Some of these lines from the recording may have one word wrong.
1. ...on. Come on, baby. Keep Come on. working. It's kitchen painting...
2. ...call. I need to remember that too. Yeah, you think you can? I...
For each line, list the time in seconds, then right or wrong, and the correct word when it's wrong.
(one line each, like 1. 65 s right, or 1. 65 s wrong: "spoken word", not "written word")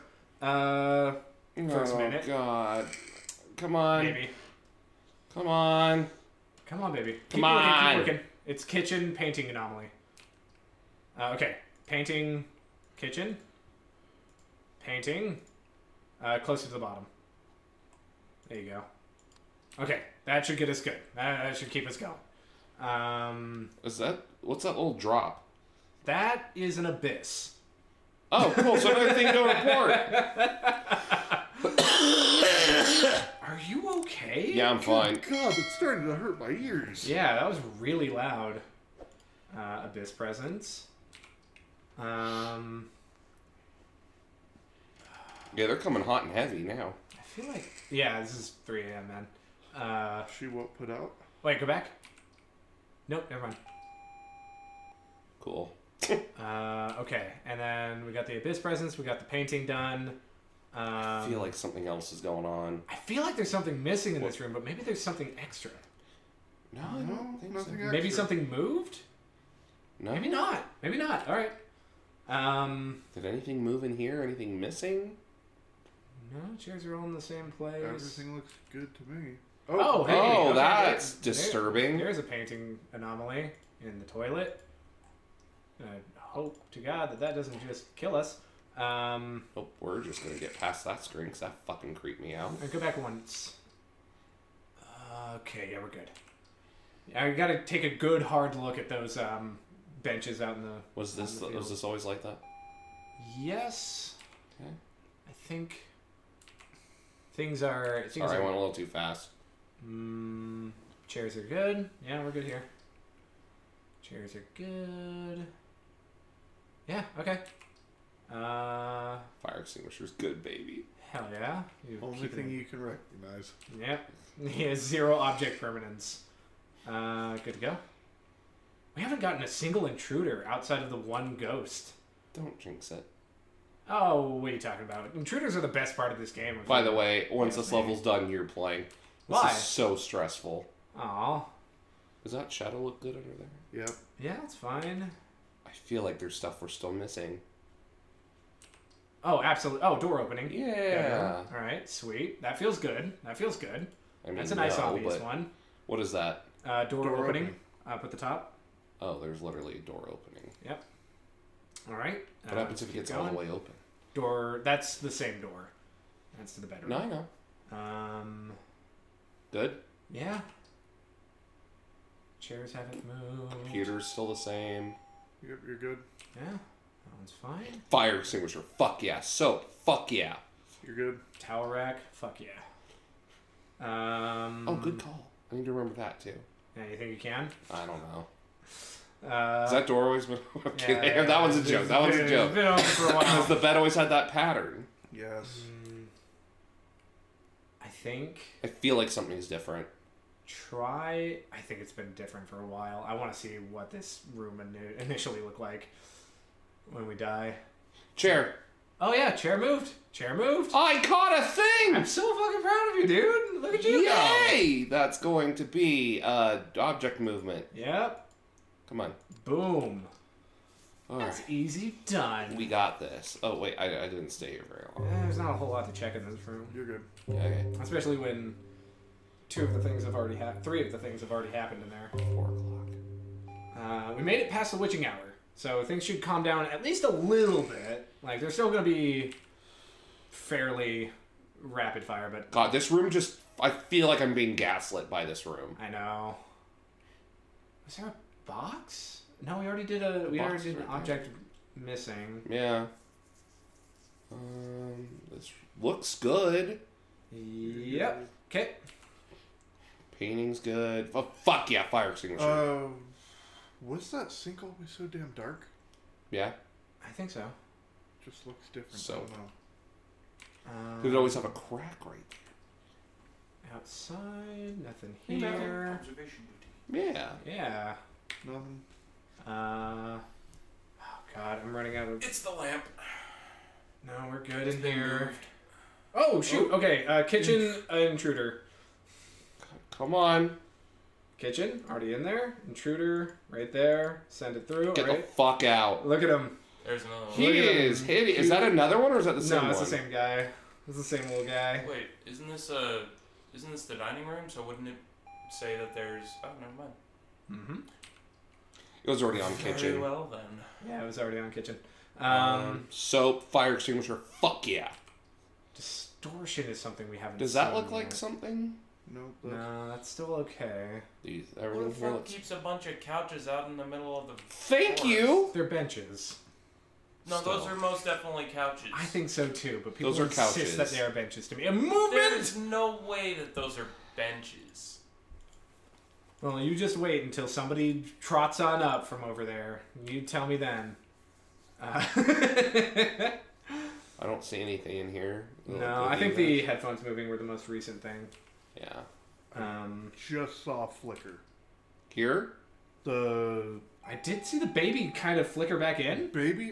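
1. 5 s right
2. 184 s right.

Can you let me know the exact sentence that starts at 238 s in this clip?
Like they're still gonna be fairly rapid fire, but God, this room just.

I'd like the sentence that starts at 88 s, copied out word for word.
Um, oh, we're just gonna get past that screen because that fucking creeped me out.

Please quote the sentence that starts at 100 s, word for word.
Was this the was this always like that?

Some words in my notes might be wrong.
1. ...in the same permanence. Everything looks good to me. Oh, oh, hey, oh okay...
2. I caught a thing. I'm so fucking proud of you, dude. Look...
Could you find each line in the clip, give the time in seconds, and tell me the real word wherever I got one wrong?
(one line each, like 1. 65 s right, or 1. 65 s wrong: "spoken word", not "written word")
1. 77 s wrong: "place", not "permanence"
2. 210 s right.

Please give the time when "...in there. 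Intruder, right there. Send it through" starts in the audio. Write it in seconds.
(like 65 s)
292 s.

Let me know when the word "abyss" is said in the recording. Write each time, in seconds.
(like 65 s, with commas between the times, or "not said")
26 s, 39 s, 58 s.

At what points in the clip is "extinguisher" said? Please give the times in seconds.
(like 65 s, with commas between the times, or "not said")
119 s, 178 s, 262 s, 313 s.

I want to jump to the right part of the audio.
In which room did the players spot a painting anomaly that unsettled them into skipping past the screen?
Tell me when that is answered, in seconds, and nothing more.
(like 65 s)
84 s.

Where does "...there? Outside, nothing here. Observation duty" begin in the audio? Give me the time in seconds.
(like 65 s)
272 s.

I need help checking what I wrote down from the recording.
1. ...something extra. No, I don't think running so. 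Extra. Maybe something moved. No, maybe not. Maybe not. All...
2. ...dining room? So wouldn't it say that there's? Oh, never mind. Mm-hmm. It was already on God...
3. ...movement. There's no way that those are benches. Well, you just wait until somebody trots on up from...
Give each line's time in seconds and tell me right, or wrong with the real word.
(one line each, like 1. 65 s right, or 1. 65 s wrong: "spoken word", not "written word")
1. 65 s wrong: "nothing", not "running"
2. 303 s wrong: "Very", not "God"
3. 331 s right.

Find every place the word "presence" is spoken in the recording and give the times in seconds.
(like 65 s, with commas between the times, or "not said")
40 s, 58 s.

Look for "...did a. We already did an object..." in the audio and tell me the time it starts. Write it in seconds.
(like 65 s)
249 s.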